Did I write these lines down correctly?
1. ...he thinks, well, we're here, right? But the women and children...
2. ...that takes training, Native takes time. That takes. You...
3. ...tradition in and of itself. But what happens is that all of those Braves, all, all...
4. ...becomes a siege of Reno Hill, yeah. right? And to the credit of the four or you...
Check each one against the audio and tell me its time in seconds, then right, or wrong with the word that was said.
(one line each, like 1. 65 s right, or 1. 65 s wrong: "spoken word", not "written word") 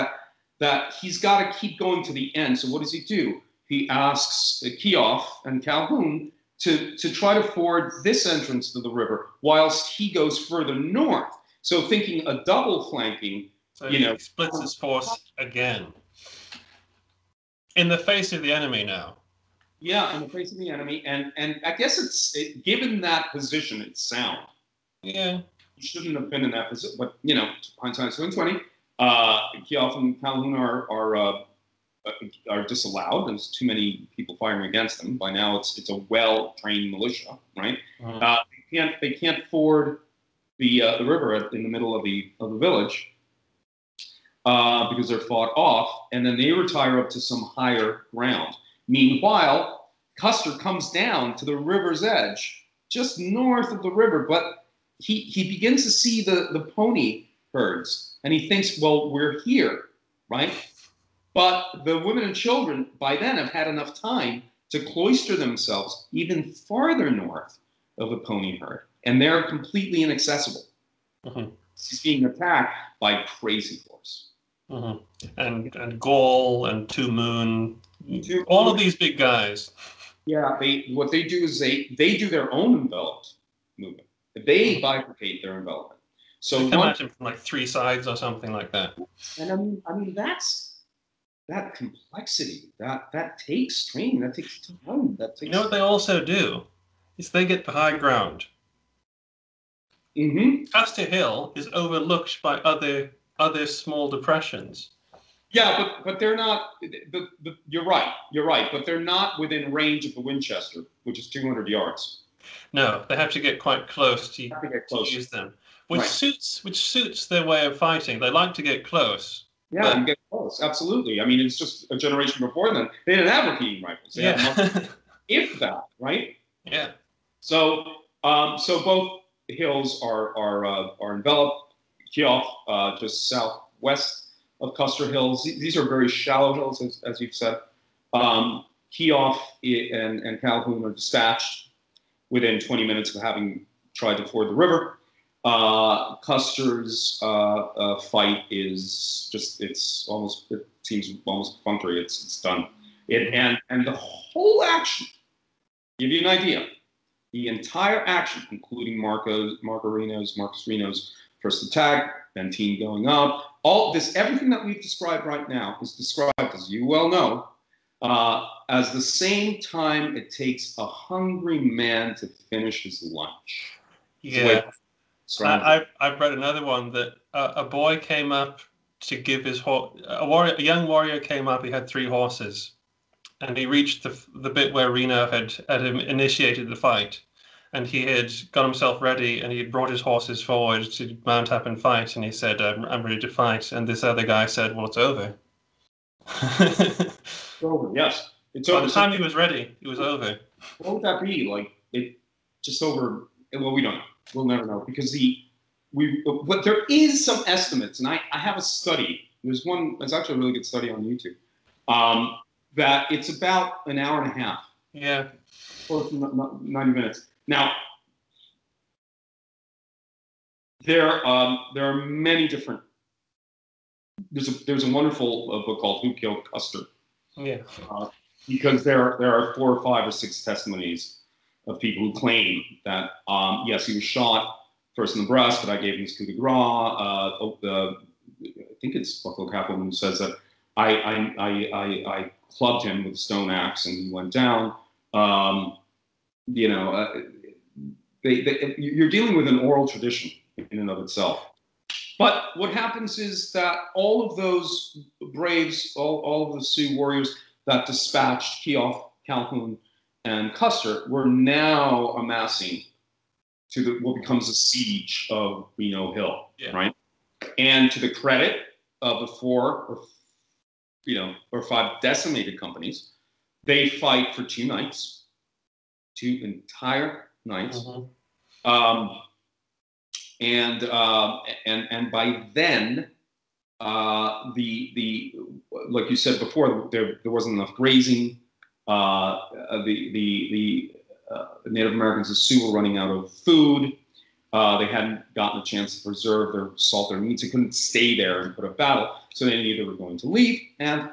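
1. 58 s right
2. 93 s wrong: "That", not "Native"
3. 249 s right
4. 264 s right.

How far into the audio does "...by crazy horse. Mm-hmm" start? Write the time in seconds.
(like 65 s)
72 s.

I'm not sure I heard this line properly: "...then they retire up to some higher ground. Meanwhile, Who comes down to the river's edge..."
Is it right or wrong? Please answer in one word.
wrong.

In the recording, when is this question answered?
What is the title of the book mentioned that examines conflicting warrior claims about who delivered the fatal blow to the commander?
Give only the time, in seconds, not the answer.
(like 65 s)
226 s.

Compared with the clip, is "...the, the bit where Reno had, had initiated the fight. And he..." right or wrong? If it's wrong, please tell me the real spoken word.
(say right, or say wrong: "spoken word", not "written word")
right.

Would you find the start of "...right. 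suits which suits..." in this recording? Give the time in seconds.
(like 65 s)
115 s.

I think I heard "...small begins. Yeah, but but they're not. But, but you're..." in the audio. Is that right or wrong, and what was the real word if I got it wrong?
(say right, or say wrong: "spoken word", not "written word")
wrong: "depressions", not "begins".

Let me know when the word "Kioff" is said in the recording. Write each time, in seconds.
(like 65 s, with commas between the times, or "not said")
132 s, 138 s.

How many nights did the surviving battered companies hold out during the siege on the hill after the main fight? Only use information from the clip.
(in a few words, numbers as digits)
2.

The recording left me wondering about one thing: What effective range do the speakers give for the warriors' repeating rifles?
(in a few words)
200 yards.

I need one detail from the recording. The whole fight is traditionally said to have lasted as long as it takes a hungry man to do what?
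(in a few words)
finish his lunch.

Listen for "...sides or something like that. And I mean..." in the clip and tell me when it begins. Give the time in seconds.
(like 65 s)
87 s.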